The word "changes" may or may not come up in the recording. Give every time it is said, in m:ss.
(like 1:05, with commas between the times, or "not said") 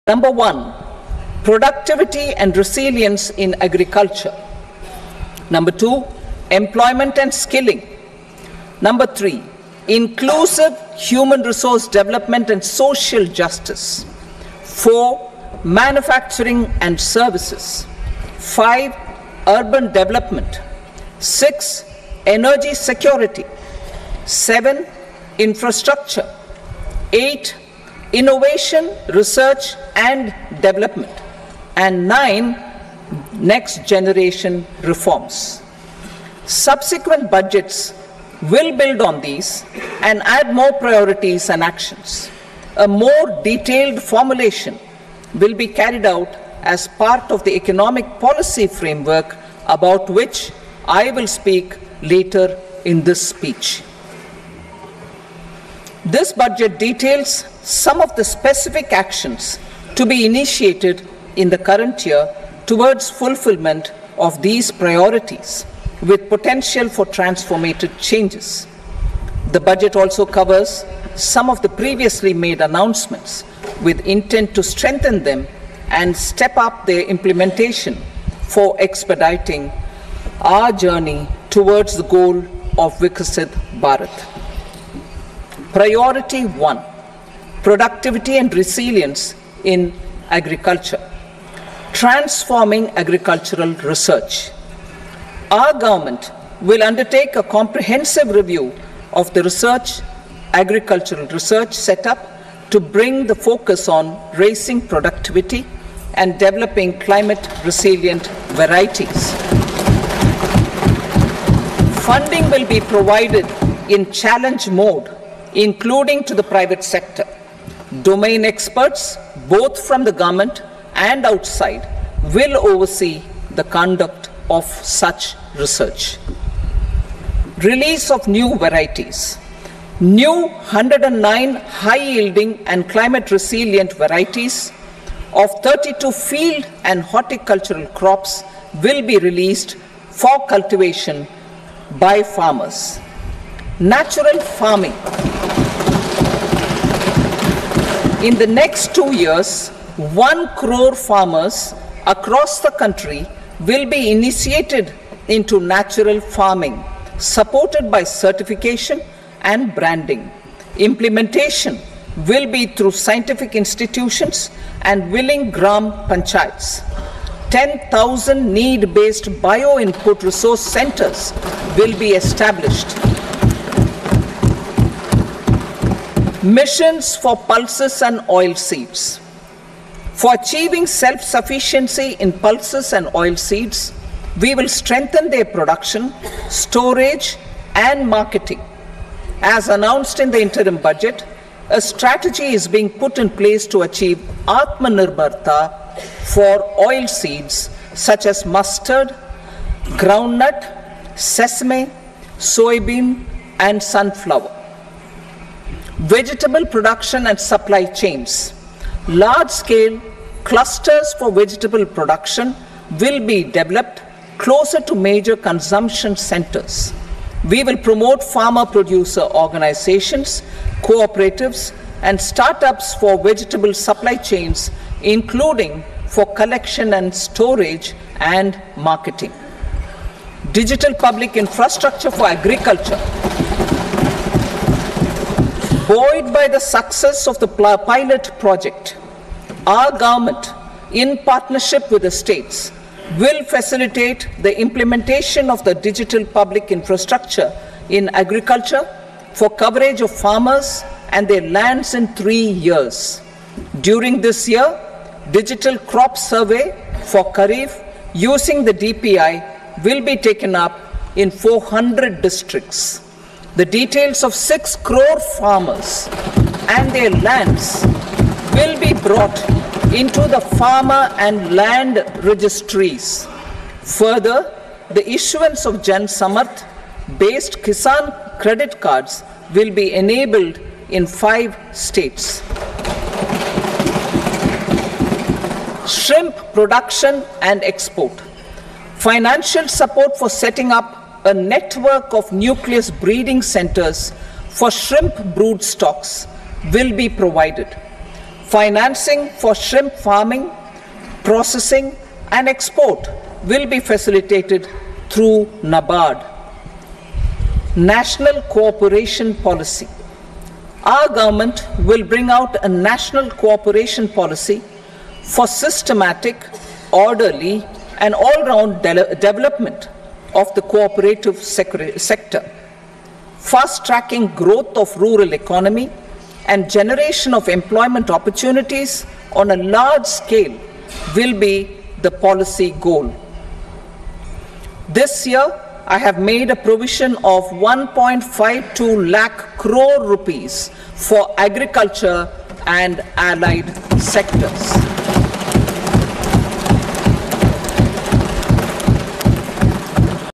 1:07.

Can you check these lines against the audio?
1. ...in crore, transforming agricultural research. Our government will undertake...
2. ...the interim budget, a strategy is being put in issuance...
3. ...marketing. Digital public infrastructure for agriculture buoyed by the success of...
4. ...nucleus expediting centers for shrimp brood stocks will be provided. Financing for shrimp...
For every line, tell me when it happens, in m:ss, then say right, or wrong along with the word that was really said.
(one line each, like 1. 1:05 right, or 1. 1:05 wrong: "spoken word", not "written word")
1. 1:29 wrong: "agriculture", not "crore"
2. 3:10 wrong: "place", not "issuance"
3. 3:48 right
4. 4:52 wrong: "breeding", not "expediting".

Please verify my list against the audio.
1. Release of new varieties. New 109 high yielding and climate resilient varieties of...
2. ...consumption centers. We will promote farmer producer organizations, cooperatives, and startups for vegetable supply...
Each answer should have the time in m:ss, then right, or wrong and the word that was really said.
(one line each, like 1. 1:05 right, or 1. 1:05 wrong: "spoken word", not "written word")
1. 2:07 right
2. 3:35 right.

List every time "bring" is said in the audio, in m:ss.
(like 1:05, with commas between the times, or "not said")
1:42, 5:12.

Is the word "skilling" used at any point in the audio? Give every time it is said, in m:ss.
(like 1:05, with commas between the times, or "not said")
0:07.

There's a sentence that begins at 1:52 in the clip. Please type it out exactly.
Funding will be provided in challenge mode, including to the private sector.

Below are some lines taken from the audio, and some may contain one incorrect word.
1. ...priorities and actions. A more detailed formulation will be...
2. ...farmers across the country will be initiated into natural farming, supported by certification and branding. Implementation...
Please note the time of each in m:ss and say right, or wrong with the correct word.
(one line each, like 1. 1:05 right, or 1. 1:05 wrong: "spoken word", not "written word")
1. 0:40 right
2. 2:30 right.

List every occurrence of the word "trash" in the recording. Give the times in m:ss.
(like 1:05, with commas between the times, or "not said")
not said.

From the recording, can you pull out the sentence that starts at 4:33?
Further, the issuance of Jan Samarth based Kisan credit cards will be enabled in five states.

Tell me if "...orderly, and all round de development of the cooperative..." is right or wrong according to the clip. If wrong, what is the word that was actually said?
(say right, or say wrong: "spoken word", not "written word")
right.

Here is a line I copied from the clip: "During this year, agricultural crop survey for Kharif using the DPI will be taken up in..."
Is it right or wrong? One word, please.
wrong.